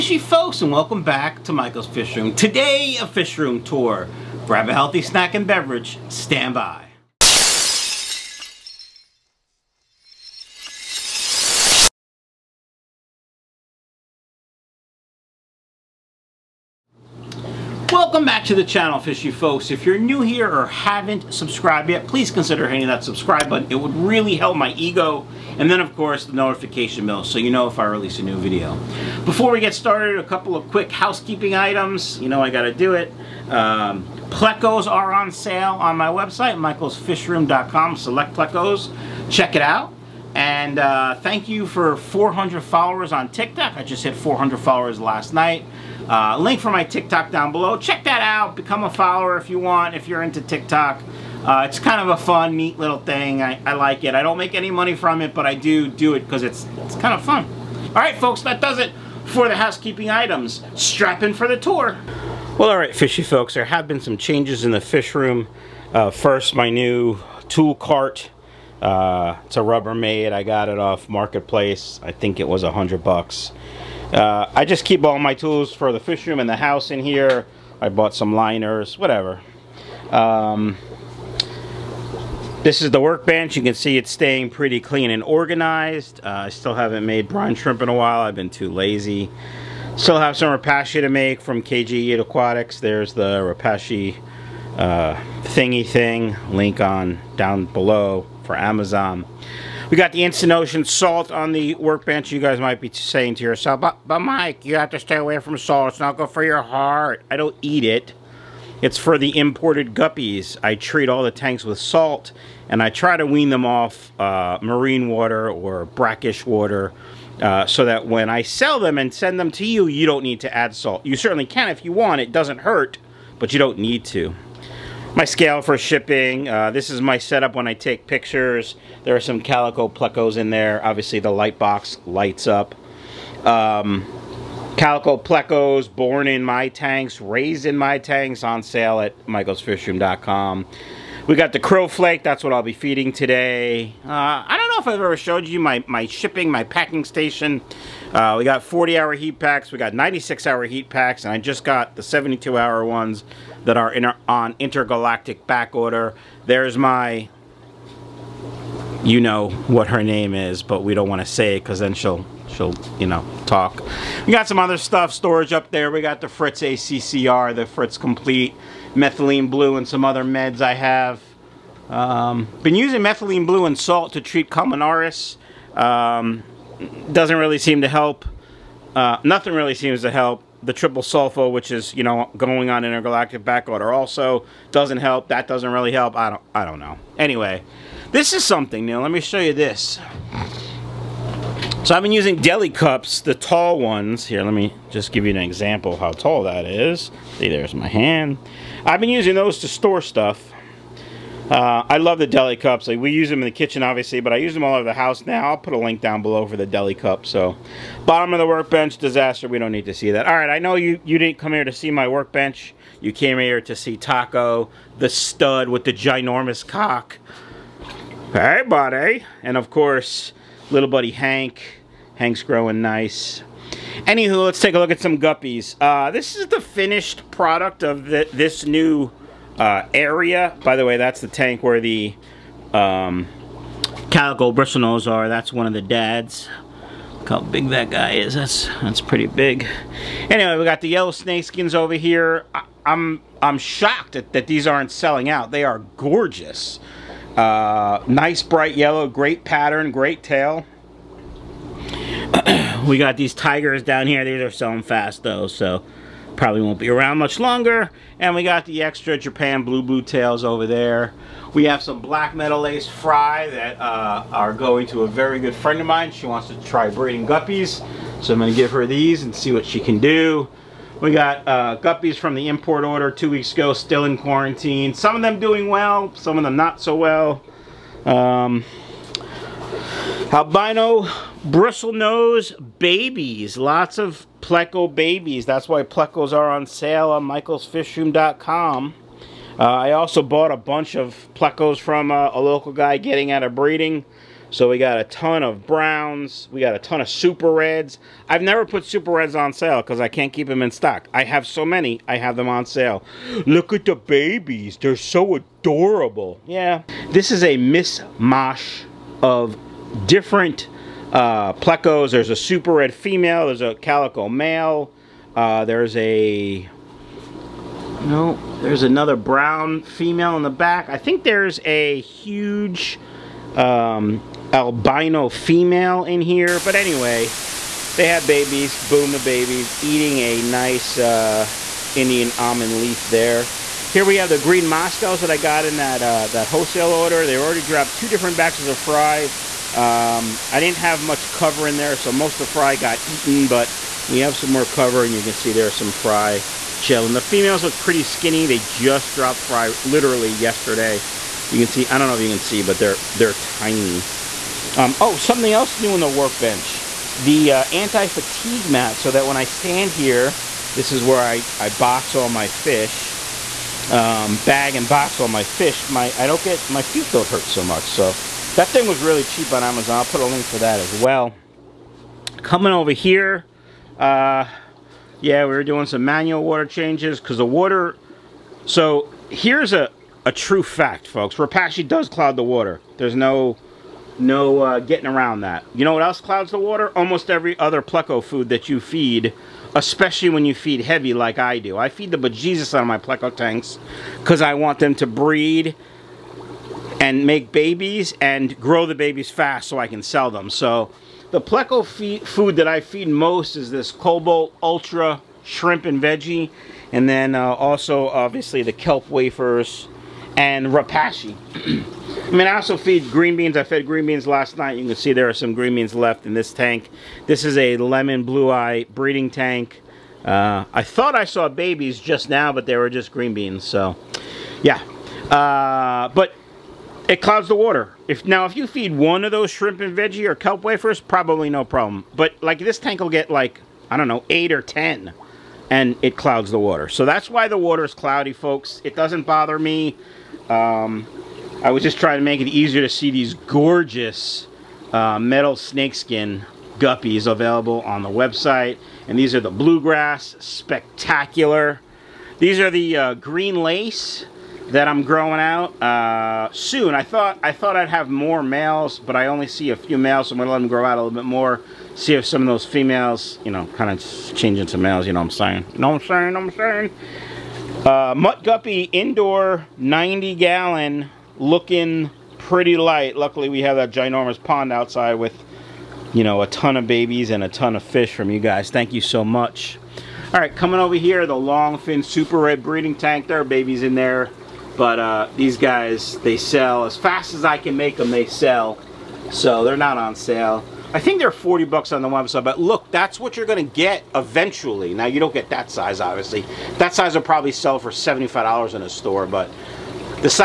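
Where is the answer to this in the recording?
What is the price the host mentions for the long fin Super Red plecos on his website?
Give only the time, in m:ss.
8:11.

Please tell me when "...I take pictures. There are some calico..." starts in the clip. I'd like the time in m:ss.
2:07.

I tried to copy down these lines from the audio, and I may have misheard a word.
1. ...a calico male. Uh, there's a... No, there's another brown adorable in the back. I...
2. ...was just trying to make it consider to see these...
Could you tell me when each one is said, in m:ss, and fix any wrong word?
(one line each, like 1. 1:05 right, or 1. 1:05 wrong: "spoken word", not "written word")
1. 5:13 wrong: "female", not "adorable"
2. 7:21 wrong: "easier", not "consider".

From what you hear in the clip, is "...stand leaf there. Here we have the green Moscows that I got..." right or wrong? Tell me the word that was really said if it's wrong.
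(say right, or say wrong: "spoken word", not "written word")
wrong: "almond", not "stand".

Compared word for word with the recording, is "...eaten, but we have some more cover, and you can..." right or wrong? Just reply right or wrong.
right.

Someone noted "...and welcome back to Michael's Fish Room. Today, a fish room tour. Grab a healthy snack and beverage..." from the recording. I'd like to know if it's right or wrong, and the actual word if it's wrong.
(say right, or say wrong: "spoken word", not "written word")
right.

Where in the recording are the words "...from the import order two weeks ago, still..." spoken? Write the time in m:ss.
4:32.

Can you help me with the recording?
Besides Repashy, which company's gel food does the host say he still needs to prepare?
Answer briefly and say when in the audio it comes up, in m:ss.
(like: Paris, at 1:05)
KJE Aquatics, at 1:31.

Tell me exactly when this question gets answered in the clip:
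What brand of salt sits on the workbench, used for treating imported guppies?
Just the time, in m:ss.
1:40.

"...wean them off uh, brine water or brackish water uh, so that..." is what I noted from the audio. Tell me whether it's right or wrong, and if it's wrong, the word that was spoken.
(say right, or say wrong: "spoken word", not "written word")
wrong: "marine", not "brine".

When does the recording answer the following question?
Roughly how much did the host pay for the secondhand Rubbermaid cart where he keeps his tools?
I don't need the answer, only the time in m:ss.
1:12.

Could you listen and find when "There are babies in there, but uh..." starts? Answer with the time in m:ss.
8:03.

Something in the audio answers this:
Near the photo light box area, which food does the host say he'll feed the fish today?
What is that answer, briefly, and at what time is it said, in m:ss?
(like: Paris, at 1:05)
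crow flake, at 2:21.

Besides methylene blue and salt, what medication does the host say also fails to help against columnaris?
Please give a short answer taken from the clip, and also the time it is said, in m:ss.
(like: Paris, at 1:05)
triple sulfa, at 3:00.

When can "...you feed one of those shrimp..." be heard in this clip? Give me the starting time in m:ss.
7:08.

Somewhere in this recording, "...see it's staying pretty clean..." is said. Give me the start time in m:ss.
1:23.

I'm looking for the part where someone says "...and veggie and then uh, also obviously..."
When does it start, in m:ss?
6:45.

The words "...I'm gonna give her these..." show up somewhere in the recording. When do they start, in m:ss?
4:28.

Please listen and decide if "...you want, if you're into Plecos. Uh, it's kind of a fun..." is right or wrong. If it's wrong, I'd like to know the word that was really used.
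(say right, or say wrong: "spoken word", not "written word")
wrong: "TikTok", not "Plecos".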